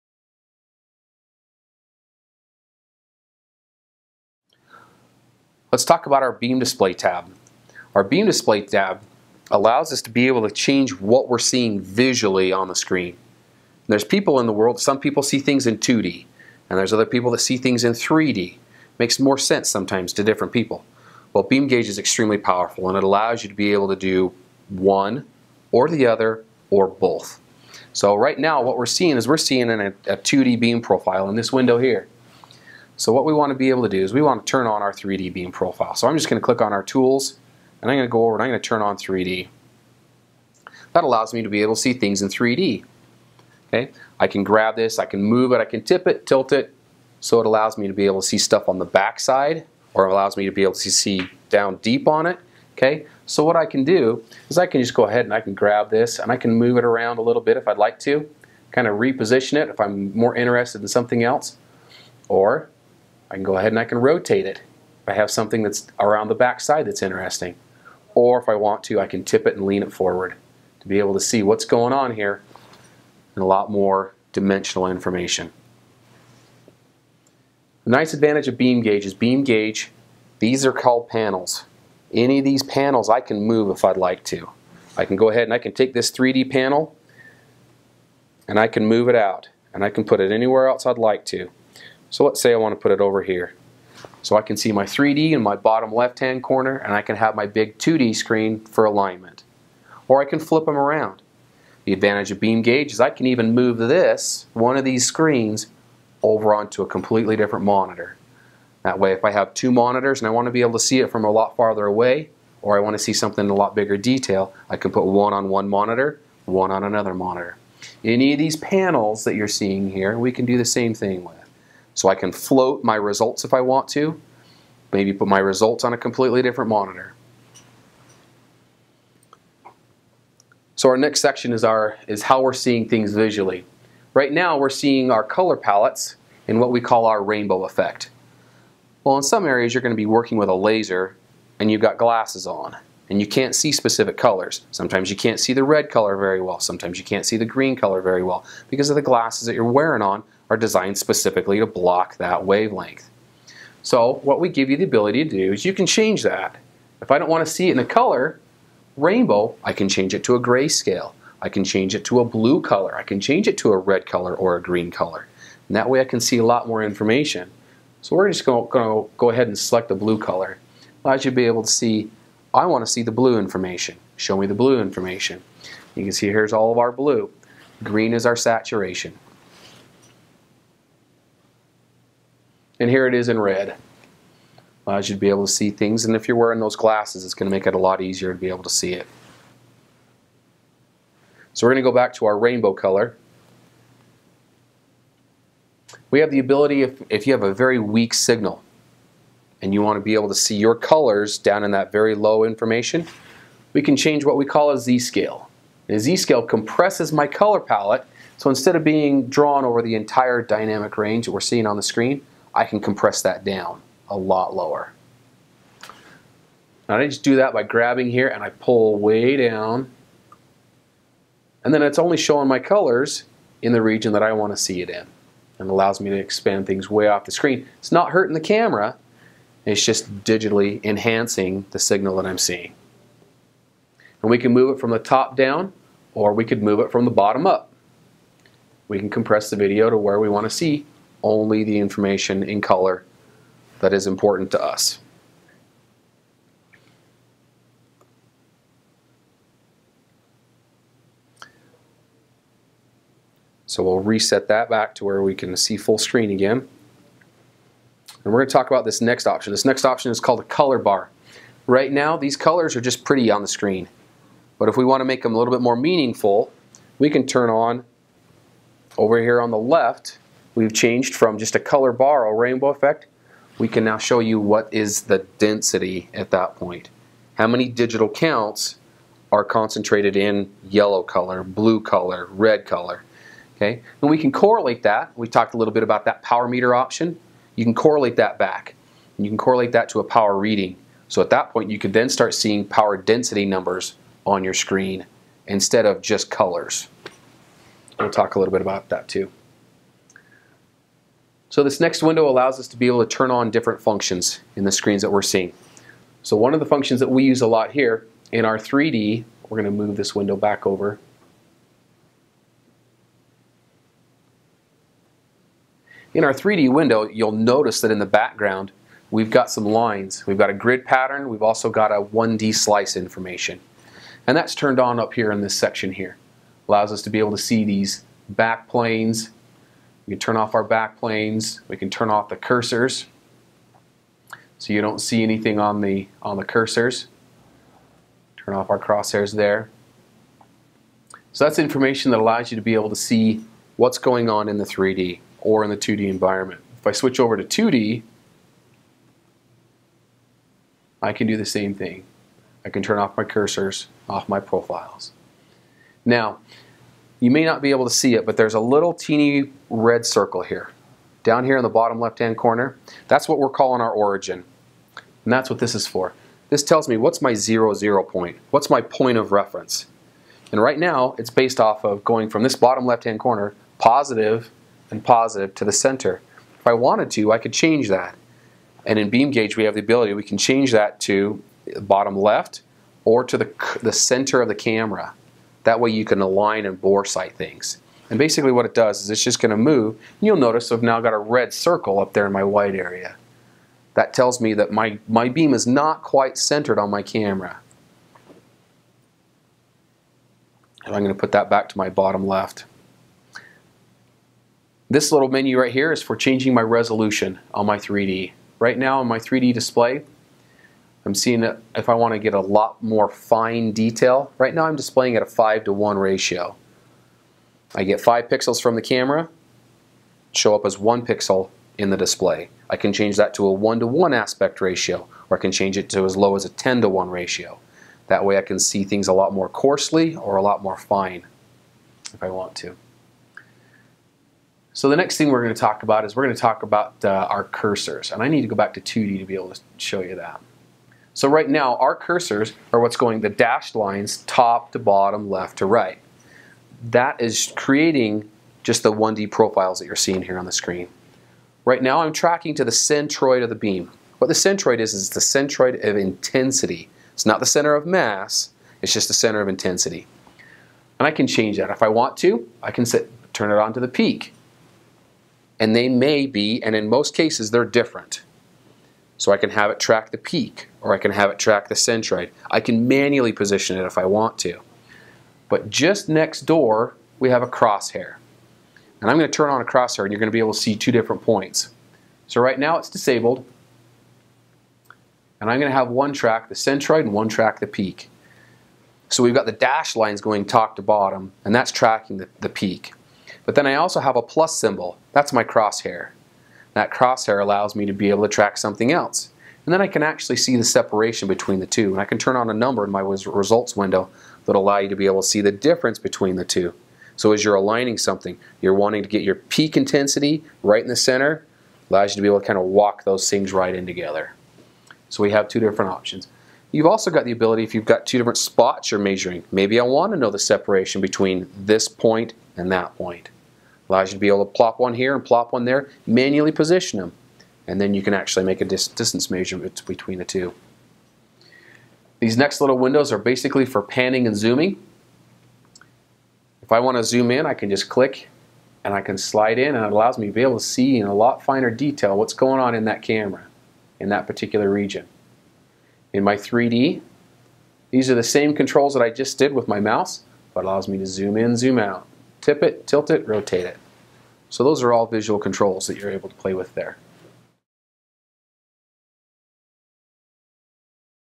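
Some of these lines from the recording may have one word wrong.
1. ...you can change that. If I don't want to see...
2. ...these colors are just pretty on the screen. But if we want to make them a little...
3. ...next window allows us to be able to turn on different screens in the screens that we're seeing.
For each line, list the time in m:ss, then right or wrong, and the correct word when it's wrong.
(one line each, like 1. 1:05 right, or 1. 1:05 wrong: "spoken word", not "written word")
1. 2:35 right
2. 4:22 right
3. 5:01 wrong: "functions", not "screens".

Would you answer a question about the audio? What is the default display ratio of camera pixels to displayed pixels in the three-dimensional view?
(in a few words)
5 to 1.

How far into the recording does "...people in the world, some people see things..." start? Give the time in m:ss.
0:14.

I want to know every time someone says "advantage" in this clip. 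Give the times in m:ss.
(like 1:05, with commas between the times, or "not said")
1:18, 1:41.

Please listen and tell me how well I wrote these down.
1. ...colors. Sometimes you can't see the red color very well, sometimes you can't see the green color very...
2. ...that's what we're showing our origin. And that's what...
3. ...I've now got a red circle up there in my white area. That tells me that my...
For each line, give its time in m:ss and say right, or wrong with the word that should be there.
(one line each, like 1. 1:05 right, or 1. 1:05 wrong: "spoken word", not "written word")
1. 2:24 right
2. 6:03 wrong: "calling", not "showing"
3. 6:30 right.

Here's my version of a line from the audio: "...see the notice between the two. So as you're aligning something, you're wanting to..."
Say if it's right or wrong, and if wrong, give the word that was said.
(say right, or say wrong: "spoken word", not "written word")
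wrong: "difference", not "notice".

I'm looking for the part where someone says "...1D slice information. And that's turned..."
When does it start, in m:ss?
5:22.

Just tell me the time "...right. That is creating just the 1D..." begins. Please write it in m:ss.
7:25.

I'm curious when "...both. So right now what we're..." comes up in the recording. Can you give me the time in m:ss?
0:26.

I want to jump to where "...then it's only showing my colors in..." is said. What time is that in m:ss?
3:41.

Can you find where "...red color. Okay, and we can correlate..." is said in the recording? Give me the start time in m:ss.
4:42.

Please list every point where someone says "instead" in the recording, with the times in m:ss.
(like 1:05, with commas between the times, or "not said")
3:28, 4:55.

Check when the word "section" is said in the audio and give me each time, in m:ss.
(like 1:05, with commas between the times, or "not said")
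2:11, 5:25.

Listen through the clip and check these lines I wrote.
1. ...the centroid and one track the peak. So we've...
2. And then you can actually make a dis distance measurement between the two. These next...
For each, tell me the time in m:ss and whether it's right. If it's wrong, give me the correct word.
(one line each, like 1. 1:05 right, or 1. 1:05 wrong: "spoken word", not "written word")
1. 8:06 right
2. 8:47 right.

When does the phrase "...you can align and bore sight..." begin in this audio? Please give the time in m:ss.
6:25.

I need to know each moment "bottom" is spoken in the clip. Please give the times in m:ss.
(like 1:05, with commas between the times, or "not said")
1:35, 3:57, 6:01, 6:12, 6:21, 6:41, 7:24, 8:10.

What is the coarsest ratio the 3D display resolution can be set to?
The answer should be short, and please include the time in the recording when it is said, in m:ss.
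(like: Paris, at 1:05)
10 to 1, at 7:06.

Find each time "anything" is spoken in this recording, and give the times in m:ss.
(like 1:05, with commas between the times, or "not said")
5:35.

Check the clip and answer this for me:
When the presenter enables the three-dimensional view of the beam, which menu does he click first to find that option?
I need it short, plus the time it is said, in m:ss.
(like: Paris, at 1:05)
tools, at 0:36.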